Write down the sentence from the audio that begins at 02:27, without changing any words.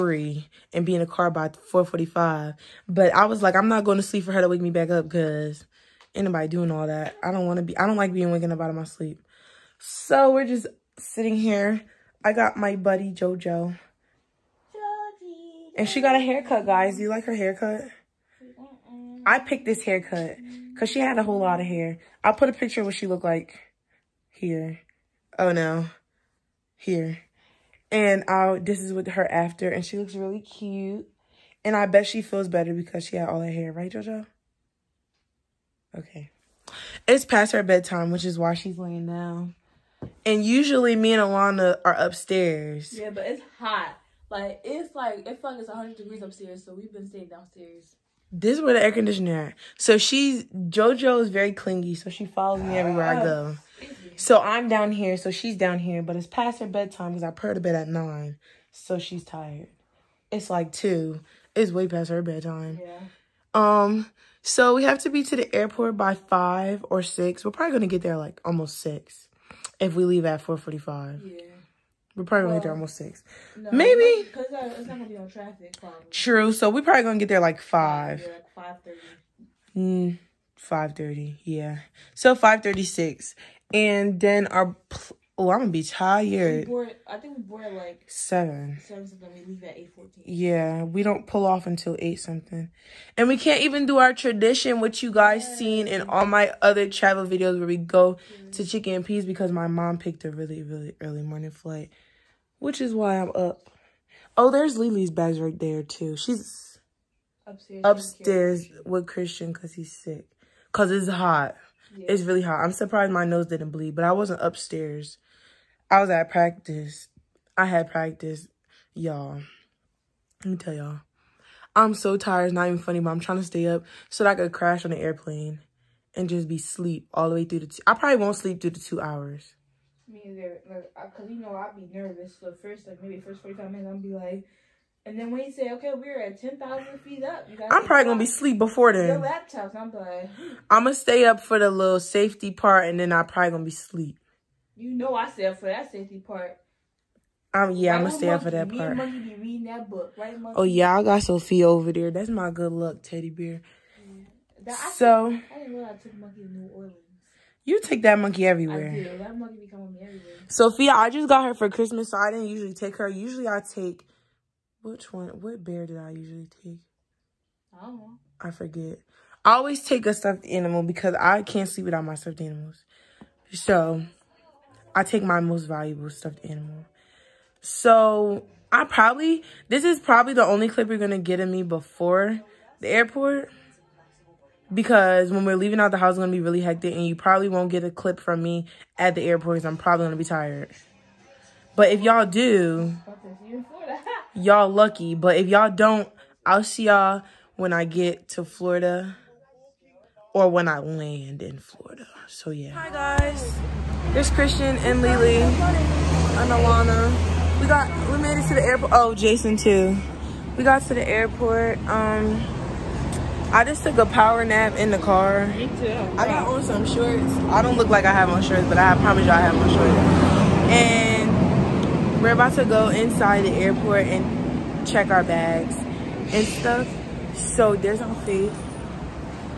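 Um, yeah, right I'm gonna stay up for that me part.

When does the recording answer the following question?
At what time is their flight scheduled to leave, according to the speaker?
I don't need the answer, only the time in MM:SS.
01:29.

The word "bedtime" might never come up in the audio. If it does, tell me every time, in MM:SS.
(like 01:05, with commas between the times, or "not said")
00:37, 00:56, 01:02.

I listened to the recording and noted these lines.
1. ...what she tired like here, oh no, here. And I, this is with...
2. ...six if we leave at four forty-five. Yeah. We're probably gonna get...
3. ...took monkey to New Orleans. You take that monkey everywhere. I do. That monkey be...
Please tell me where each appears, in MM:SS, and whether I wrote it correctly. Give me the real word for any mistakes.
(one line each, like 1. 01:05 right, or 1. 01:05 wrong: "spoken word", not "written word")
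1. 00:22 wrong: "looked", not "tired"
2. 01:08 right
3. 02:35 right.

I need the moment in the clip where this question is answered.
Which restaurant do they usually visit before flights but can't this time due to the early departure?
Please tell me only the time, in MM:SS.
01:38.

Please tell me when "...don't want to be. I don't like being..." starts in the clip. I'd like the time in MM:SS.
00:07.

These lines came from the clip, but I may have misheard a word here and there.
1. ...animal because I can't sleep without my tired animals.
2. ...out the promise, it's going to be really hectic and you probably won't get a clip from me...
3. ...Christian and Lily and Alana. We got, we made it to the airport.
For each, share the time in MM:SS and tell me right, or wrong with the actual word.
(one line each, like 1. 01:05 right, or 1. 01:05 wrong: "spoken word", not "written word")
1. 02:50 wrong: "stuffed", not "tired"
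2. 03:05 wrong: "house", not "promise"
3. 03:24 right.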